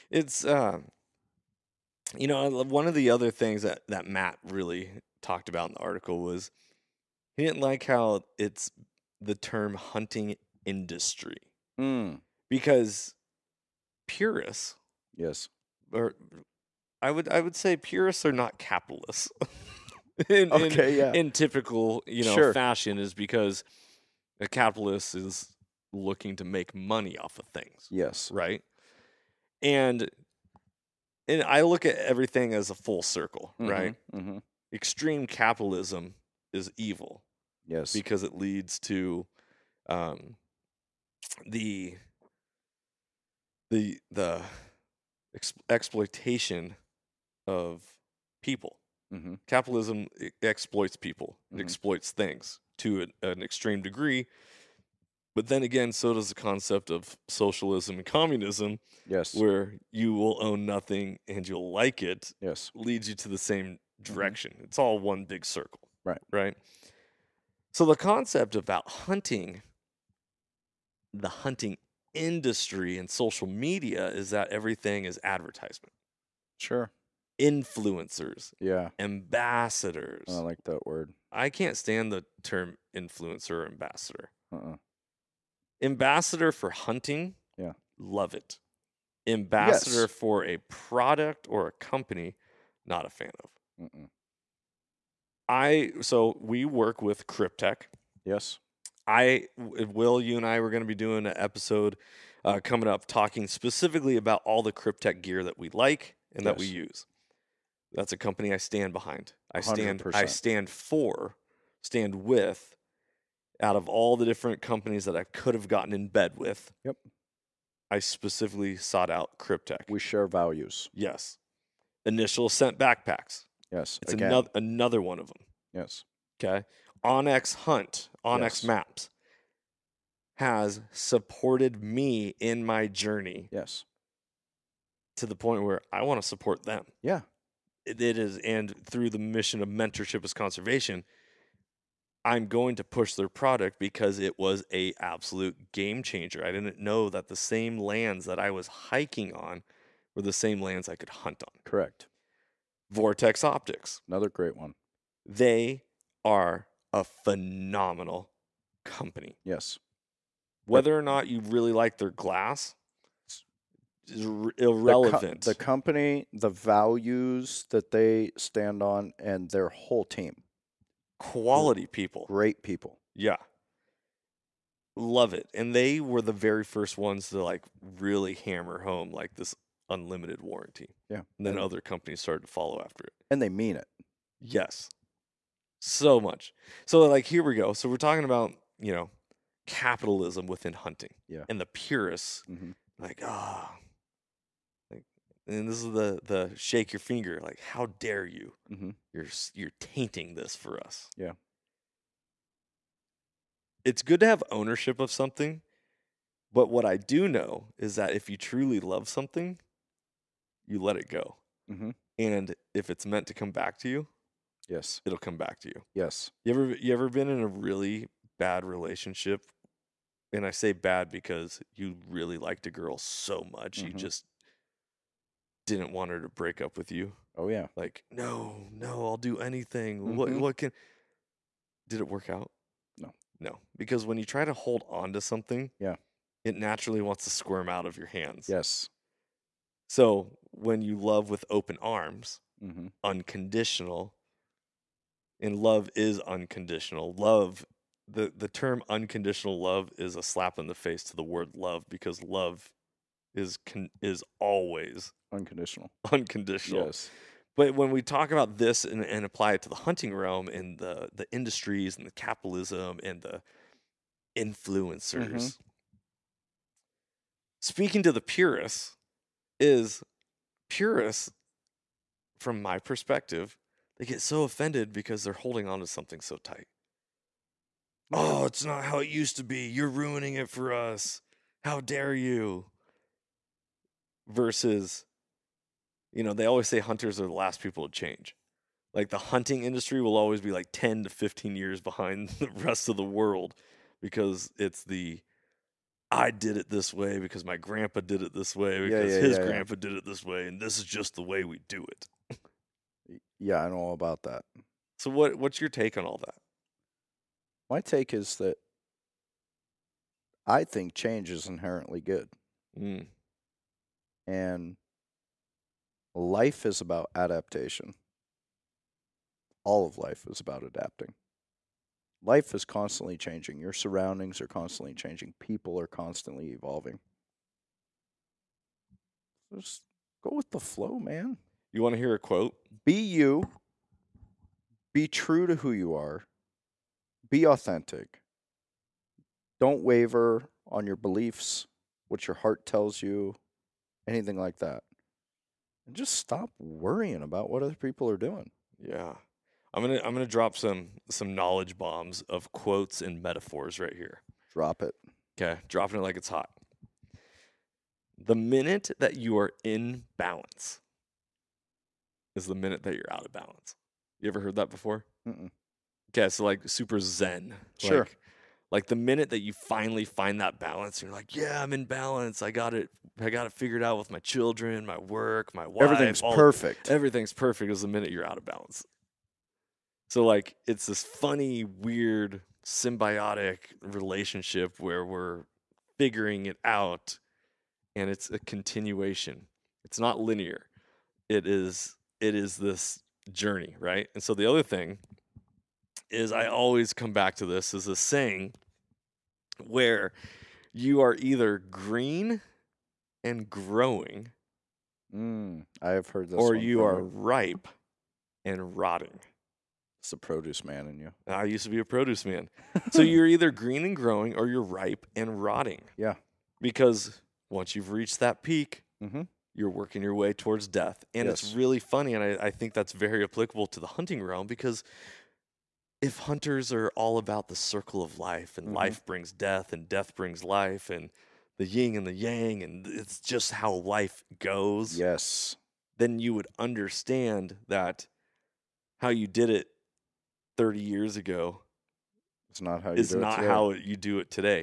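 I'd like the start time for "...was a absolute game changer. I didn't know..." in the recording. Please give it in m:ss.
2:24.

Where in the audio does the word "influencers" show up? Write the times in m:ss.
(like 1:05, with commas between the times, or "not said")
1:17, 1:22, 4:24.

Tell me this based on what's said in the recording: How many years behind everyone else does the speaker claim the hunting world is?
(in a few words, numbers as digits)
10 to 15.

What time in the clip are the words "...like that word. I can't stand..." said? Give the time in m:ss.
1:20.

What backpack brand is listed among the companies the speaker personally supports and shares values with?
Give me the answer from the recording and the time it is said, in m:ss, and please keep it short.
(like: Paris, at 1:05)
Initial Ascent, at 2:02.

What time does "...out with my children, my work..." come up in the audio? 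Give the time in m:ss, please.
6:13.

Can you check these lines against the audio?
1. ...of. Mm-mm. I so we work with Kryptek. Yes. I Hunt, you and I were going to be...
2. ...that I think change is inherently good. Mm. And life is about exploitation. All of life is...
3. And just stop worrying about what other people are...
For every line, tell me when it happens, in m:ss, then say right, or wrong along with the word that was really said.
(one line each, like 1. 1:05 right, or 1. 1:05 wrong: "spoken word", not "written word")
1. 1:33 wrong: "Will", not "Hunt"
2. 5:08 wrong: "adaptation", not "exploitation"
3. 5:45 right.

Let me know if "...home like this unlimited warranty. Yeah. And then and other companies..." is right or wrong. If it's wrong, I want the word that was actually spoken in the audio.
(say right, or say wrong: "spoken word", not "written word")
right.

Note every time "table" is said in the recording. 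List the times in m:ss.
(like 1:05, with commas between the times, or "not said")
not said.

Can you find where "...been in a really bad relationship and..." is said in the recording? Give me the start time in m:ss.
3:37.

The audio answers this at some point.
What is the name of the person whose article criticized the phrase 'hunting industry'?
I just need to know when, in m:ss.
0:04.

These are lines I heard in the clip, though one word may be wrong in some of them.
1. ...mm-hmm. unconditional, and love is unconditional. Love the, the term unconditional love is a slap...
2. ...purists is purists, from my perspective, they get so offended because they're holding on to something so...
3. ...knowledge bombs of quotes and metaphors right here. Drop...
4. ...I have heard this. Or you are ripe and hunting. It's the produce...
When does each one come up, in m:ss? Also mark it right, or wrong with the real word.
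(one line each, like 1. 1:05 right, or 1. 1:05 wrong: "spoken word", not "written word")
1. 4:02 right
2. 4:28 right
3. 5:51 right
4. 6:45 wrong: "rotting", not "hunting".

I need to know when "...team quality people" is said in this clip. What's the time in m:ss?
2:50.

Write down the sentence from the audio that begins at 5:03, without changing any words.
yeah, I know all about that.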